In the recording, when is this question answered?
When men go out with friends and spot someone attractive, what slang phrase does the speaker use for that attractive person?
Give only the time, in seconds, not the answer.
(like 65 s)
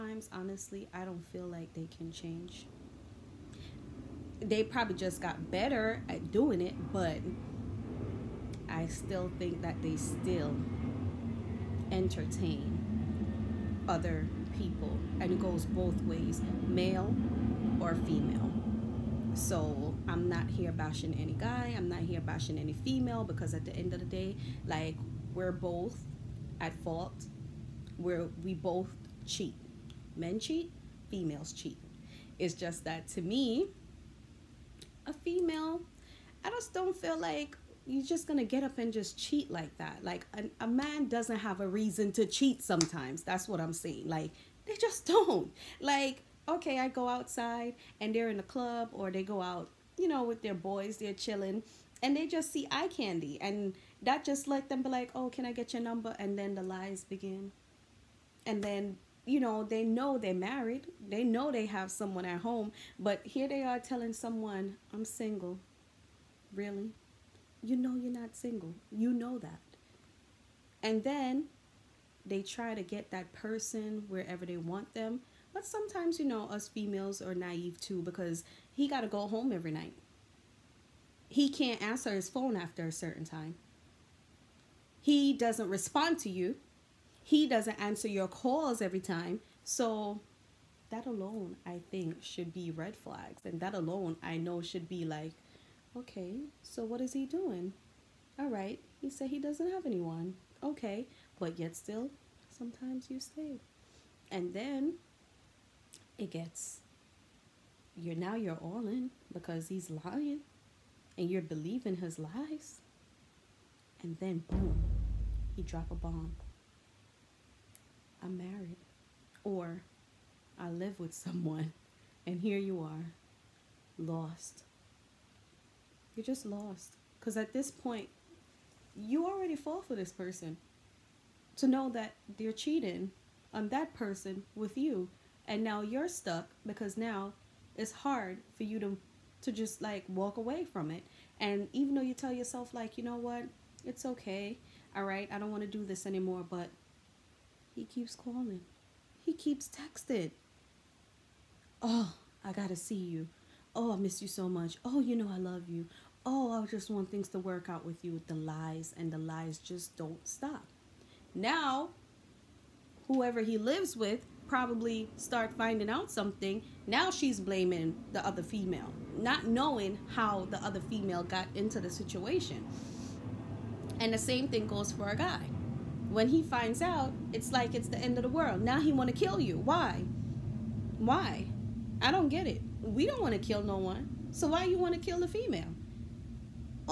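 52 s.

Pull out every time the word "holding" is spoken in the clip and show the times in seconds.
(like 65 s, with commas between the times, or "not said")
not said.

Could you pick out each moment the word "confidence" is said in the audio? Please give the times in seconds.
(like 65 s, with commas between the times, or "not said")
not said.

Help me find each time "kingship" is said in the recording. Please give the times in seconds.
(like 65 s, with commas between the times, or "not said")
not said.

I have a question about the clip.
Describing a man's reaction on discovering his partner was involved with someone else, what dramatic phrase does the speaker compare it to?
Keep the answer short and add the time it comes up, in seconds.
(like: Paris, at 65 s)
the end of the world, at 177 s.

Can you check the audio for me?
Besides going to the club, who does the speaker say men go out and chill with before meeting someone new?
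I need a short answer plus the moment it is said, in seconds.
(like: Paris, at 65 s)
their boys, at 50 s.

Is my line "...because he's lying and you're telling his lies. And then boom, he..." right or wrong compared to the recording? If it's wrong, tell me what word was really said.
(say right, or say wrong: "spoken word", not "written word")
wrong: "believing", not "telling".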